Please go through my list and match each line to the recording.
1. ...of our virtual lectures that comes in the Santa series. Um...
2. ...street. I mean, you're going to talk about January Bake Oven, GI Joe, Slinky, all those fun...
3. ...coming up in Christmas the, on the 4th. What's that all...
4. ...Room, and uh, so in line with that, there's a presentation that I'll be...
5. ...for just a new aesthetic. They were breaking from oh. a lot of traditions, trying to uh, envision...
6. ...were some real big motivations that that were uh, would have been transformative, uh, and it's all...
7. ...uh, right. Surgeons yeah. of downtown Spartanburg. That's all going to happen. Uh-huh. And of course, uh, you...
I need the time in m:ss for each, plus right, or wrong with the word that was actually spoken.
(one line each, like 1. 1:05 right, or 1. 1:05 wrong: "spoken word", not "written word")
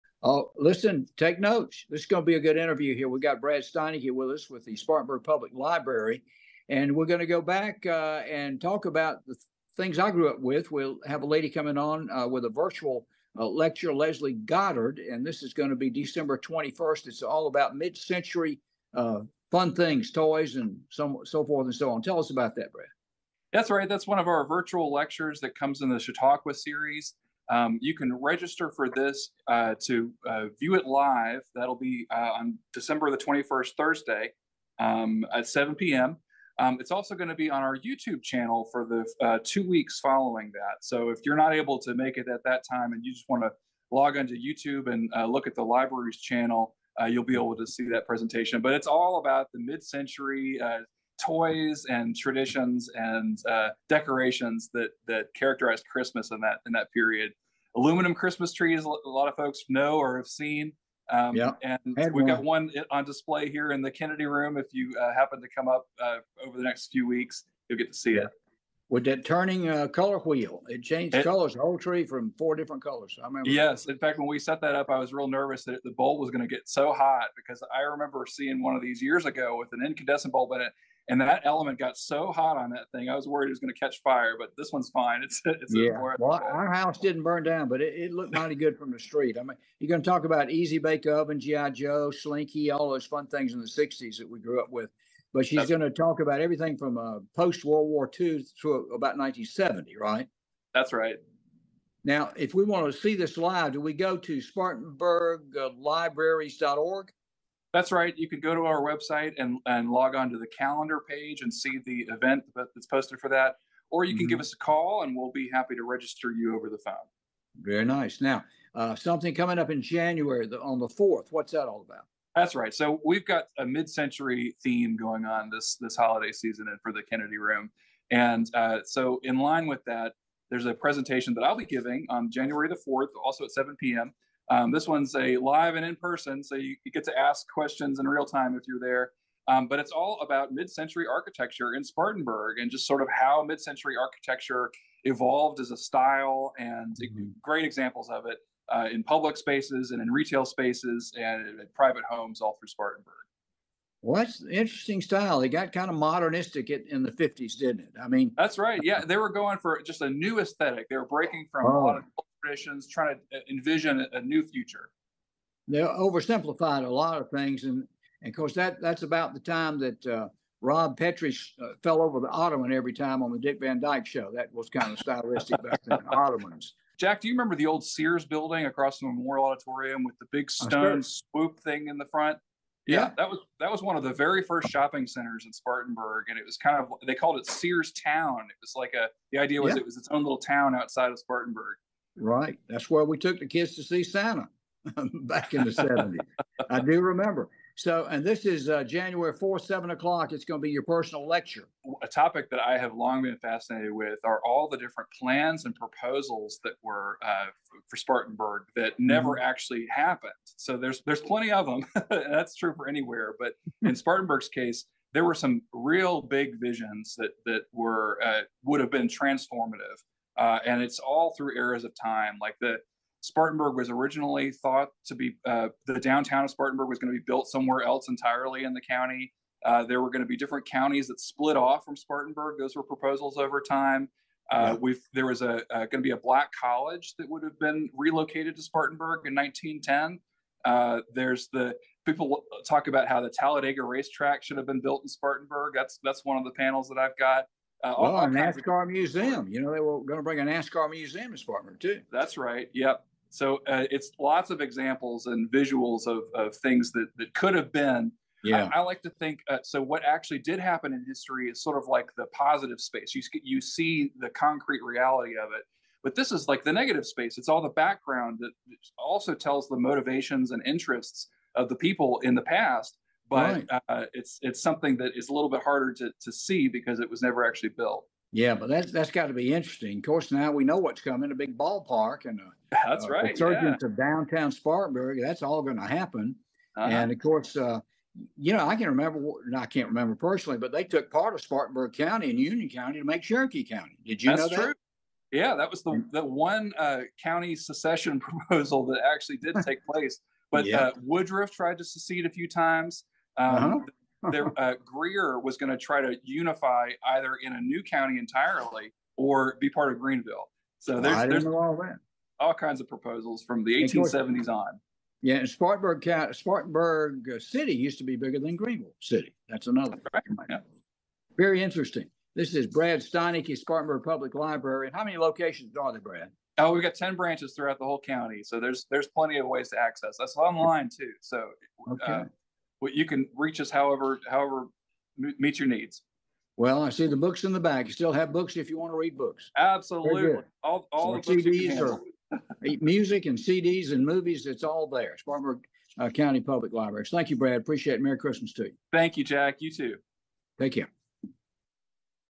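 1. 0:24 wrong: "Chautauqua", not "Santa"
2. 1:28 wrong: "Easy", not "January"
3. 1:59 wrong: "January", not "Christmas"
4. 2:07 right
5. 2:39 right
6. 3:35 wrong: "visions", not "motivations"
7. 4:43 right.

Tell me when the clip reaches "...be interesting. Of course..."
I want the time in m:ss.
4:39.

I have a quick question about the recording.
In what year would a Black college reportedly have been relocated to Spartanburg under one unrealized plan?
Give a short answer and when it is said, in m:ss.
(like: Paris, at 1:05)
1910, at 3:59.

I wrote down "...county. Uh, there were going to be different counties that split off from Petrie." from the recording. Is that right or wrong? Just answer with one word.
wrong.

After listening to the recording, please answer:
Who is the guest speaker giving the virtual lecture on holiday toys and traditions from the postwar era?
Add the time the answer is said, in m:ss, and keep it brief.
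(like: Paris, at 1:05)
Leslie Goddard, at 0:13.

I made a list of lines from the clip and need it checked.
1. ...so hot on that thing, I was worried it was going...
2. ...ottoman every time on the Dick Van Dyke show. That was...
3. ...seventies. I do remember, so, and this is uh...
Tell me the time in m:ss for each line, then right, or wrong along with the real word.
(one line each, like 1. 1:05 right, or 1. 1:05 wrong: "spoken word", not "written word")
1. 1:21 right
2. 2:52 right
3. 3:15 right.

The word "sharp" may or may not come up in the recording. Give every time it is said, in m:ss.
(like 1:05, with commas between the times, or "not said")
not said.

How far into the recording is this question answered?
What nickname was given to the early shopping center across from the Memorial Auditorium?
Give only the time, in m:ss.
3:07.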